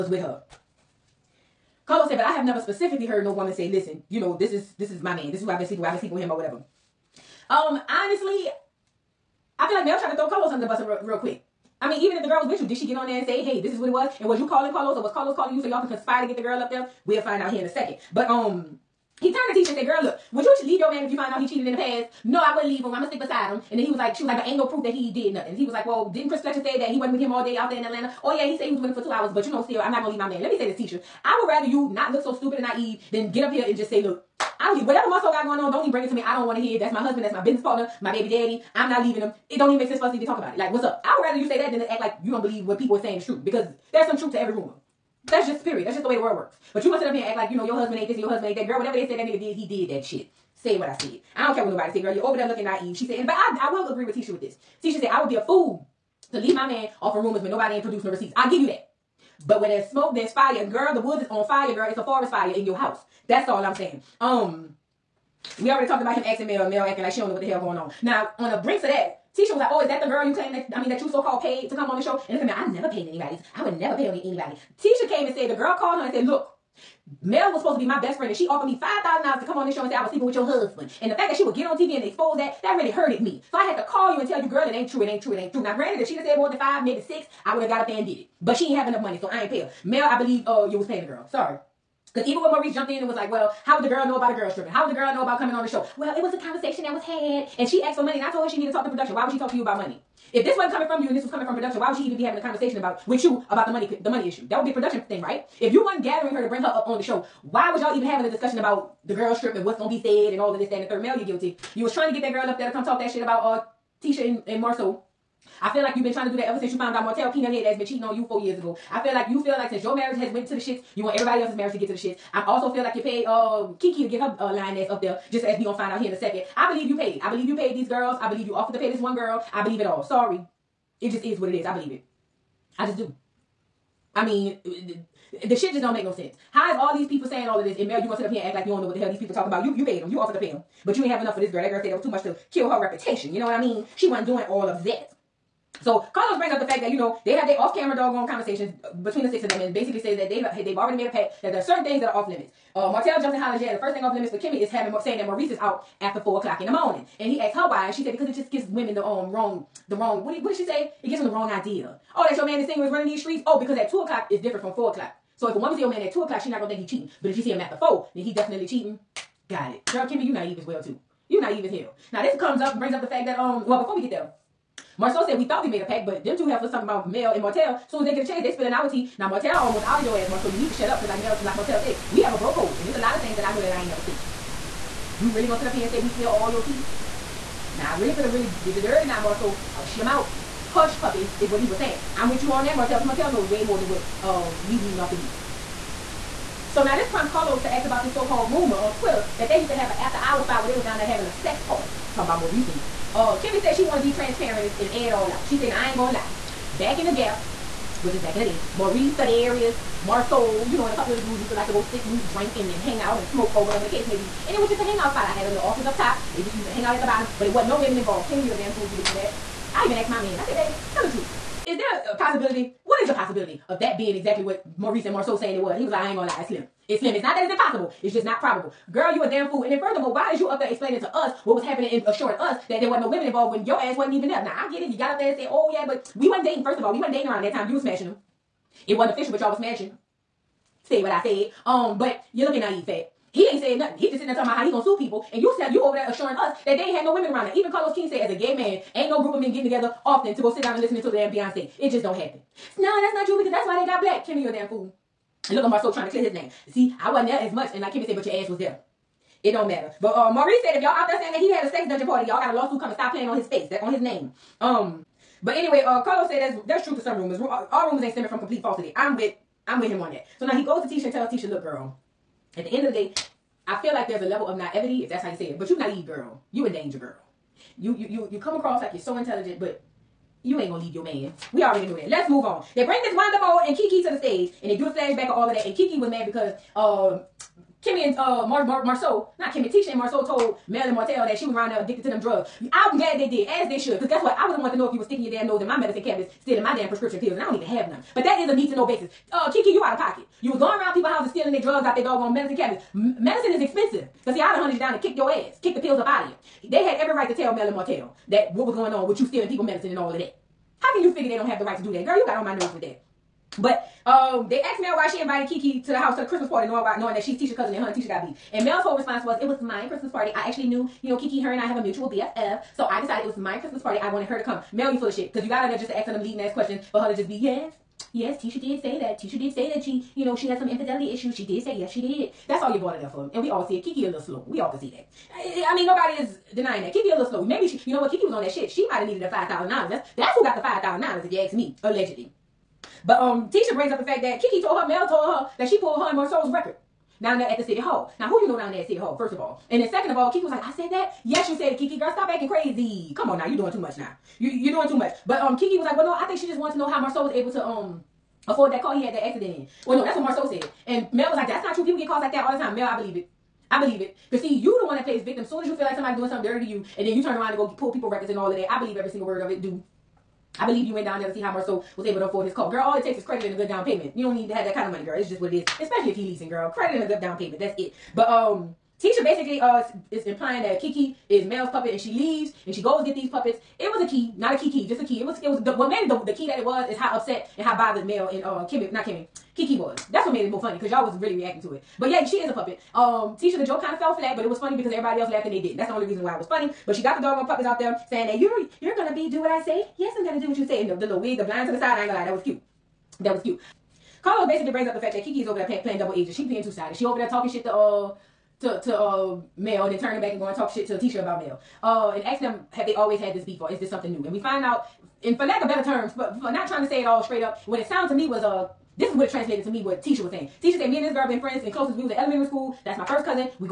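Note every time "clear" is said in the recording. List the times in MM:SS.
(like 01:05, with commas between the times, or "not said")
04:16.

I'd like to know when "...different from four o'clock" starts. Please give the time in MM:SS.
02:44.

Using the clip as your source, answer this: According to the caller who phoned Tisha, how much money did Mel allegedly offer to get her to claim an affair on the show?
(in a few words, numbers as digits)
$5,000.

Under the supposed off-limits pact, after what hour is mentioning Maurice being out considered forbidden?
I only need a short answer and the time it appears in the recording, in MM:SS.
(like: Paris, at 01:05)
4 a.m., at 02:36.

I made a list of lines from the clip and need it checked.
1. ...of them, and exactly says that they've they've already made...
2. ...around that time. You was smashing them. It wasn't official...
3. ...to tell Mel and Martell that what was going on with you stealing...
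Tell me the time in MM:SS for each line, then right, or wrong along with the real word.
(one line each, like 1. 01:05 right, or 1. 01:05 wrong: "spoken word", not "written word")
1. 02:29 wrong: "basically", not "exactly"
2. 03:57 right
3. 05:07 right.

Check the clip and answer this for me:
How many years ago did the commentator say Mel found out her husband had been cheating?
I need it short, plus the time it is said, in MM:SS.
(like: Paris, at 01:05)
4, at 01:58.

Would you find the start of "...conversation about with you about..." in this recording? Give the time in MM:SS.
01:42.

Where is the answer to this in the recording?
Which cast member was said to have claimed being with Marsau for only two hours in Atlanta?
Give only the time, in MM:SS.
00:26.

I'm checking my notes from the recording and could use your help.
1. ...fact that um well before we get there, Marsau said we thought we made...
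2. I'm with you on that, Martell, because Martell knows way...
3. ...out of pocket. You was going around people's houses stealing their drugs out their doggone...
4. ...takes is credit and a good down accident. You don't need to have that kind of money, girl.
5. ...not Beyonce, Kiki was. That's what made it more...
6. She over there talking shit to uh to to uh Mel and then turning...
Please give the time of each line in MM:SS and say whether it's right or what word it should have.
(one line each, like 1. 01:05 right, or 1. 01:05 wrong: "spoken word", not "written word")
1. 02:53 right
2. 03:12 right
3. 04:59 right
4. 06:13 wrong: "payment", not "accident"
5. 06:28 wrong: "Kimmy", not "Beyonce"
6. 06:46 right.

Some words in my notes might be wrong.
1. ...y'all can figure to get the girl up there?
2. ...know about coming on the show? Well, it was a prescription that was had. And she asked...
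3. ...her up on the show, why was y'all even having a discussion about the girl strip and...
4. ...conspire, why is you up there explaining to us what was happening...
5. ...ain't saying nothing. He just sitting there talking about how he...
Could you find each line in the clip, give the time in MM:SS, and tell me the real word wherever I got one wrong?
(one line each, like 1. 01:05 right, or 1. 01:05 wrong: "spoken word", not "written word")
1. 00:15 wrong: "conspire", not "figure"
2. 01:35 wrong: "conversation", not "prescription"
3. 01:46 right
4. 03:49 wrong: "furthermore", not "conspire"
5. 04:03 right.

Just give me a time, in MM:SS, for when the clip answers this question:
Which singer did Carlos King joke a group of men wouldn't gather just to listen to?
04:11.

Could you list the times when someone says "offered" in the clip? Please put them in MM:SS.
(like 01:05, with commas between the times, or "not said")
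01:18, 02:08, 02:20.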